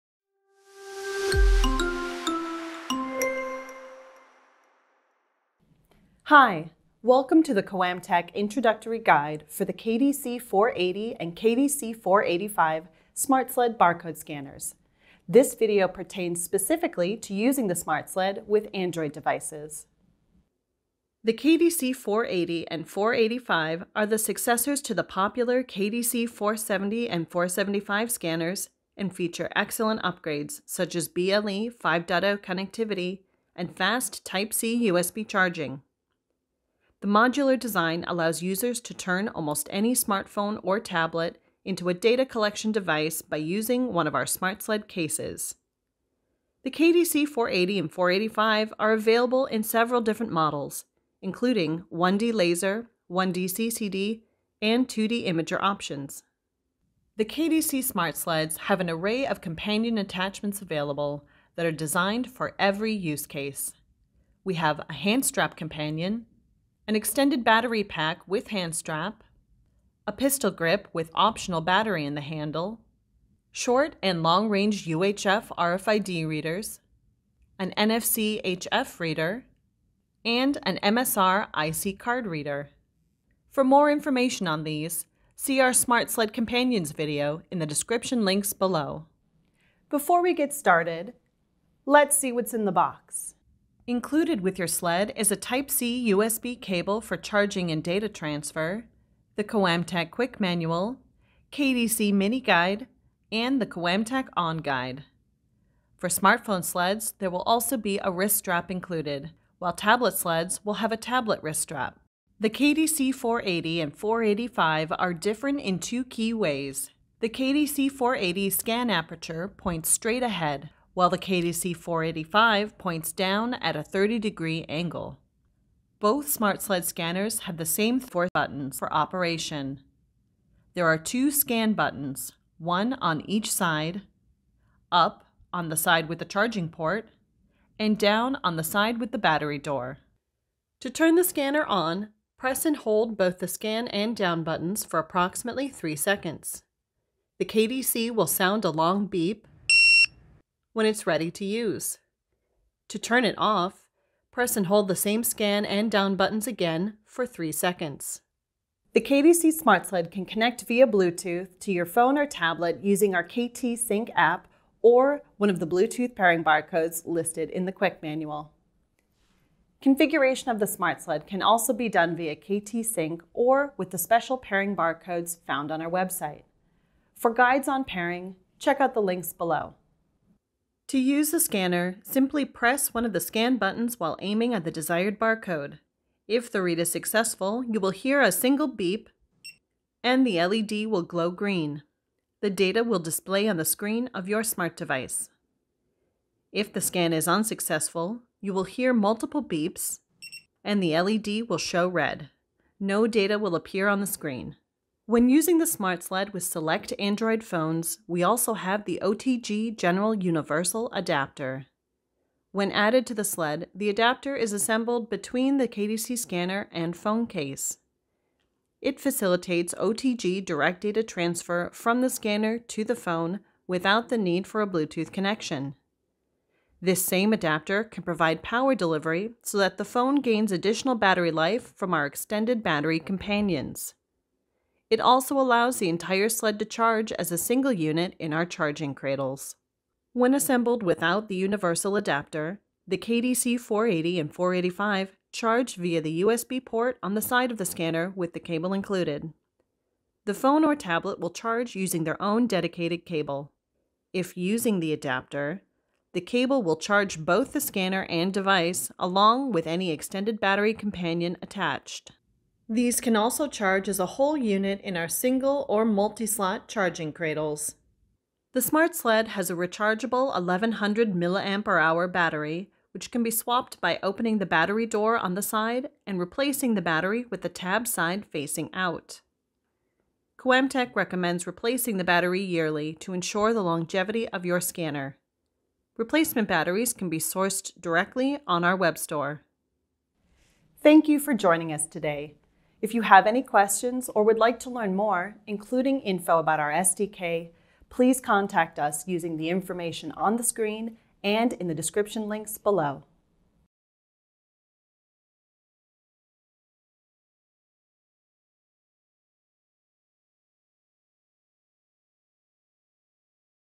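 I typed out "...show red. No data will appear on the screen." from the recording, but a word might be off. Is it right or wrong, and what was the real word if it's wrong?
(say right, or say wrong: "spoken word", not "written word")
right.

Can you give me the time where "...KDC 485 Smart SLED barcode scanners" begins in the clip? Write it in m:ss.
0:11.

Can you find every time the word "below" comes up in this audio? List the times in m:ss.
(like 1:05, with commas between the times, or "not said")
1:28, 2:59, 5:02.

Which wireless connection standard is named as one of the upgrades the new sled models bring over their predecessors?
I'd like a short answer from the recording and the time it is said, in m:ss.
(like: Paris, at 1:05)
BLE 5.0, at 0:31.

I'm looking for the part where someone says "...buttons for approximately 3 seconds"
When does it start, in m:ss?
2:24.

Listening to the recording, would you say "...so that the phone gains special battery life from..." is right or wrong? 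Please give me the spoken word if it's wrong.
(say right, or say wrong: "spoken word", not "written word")
wrong: "additional", not "special".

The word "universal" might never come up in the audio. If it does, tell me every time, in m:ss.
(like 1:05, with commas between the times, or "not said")
3:30, 4:01.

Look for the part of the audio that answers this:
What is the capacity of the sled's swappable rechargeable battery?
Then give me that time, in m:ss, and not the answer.
4:30.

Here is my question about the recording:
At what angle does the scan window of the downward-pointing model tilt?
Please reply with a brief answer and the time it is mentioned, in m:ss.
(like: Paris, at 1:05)
30 degrees, at 2:03.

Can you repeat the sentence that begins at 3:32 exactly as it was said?
When added to the sled, the adapter is assembled between the KDC scanner and phone case.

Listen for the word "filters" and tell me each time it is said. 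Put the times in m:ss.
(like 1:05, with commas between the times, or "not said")
not said.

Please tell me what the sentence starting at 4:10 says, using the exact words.
The phone or tablet will charge using their own dedicated cable.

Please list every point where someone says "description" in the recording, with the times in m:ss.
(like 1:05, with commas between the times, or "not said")
1:27, 5:01.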